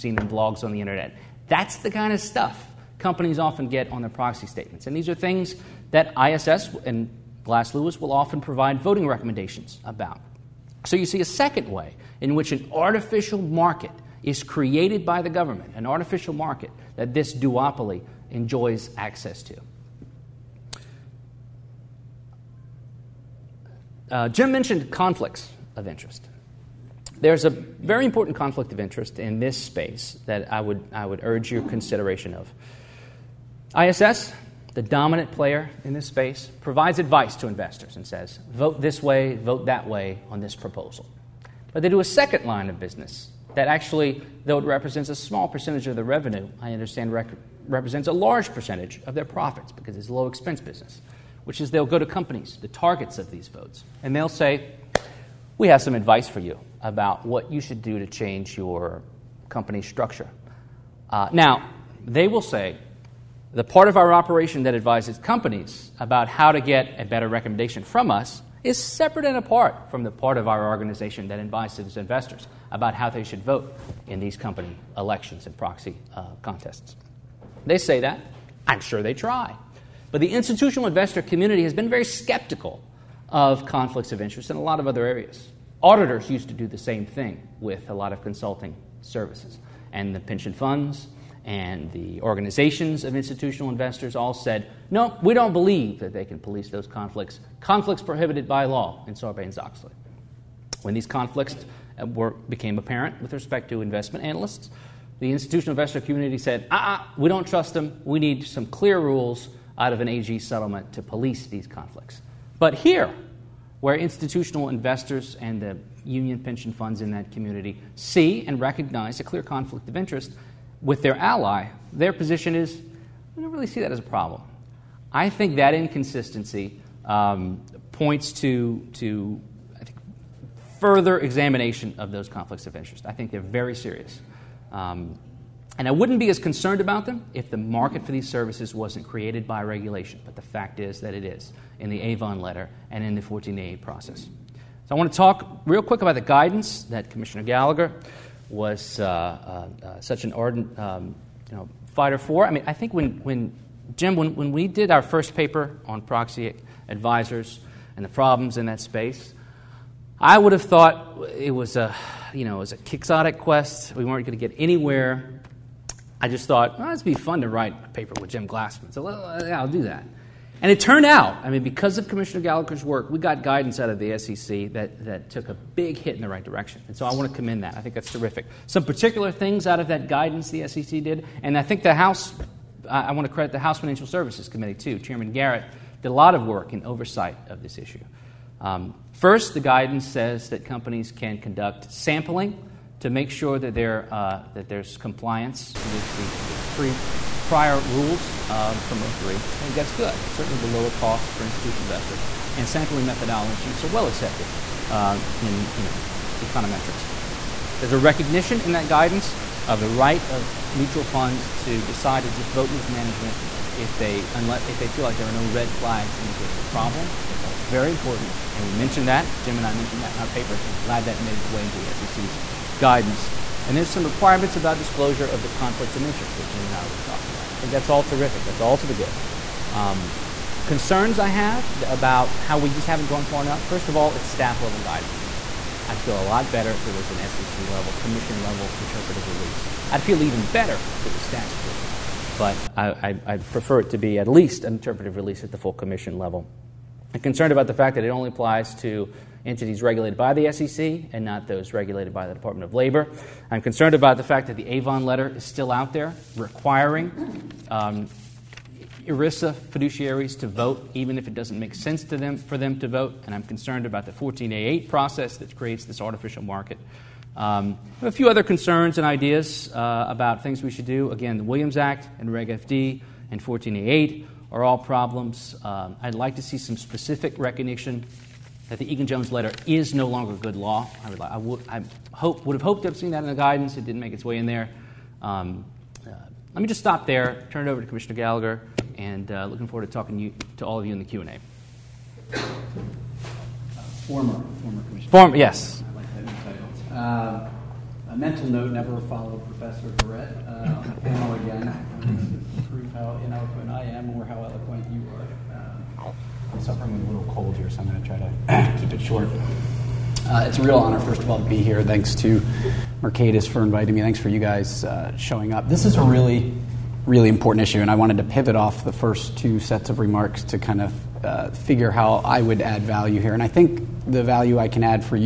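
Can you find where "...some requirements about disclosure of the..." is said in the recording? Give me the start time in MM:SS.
03:43.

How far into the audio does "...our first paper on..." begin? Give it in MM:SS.
02:34.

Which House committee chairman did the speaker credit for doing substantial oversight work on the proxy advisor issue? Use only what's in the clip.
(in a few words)
Chairman Garrett.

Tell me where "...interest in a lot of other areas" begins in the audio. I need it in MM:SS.
01:24.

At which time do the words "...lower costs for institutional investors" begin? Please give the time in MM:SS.
03:20.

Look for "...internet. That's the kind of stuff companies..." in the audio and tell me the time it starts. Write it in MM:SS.
00:00.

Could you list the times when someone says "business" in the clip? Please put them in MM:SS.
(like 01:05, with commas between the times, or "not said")
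00:42, 00:50.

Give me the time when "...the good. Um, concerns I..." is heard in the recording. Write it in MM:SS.
03:48.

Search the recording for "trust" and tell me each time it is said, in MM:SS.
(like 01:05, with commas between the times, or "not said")
01:47.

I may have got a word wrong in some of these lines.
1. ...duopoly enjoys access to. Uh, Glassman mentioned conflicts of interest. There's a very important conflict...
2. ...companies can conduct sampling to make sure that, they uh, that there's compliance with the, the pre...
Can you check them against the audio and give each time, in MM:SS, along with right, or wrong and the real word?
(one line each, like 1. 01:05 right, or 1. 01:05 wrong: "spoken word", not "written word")
1. 00:17 wrong: "Jim", not "Glassman"
2. 03:10 right.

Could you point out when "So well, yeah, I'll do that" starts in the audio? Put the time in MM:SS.
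02:48.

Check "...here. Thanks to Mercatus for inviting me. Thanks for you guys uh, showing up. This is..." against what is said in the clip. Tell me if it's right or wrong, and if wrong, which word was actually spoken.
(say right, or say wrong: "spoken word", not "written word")
right.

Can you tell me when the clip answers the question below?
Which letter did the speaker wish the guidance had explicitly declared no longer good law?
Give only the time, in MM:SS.
04:38.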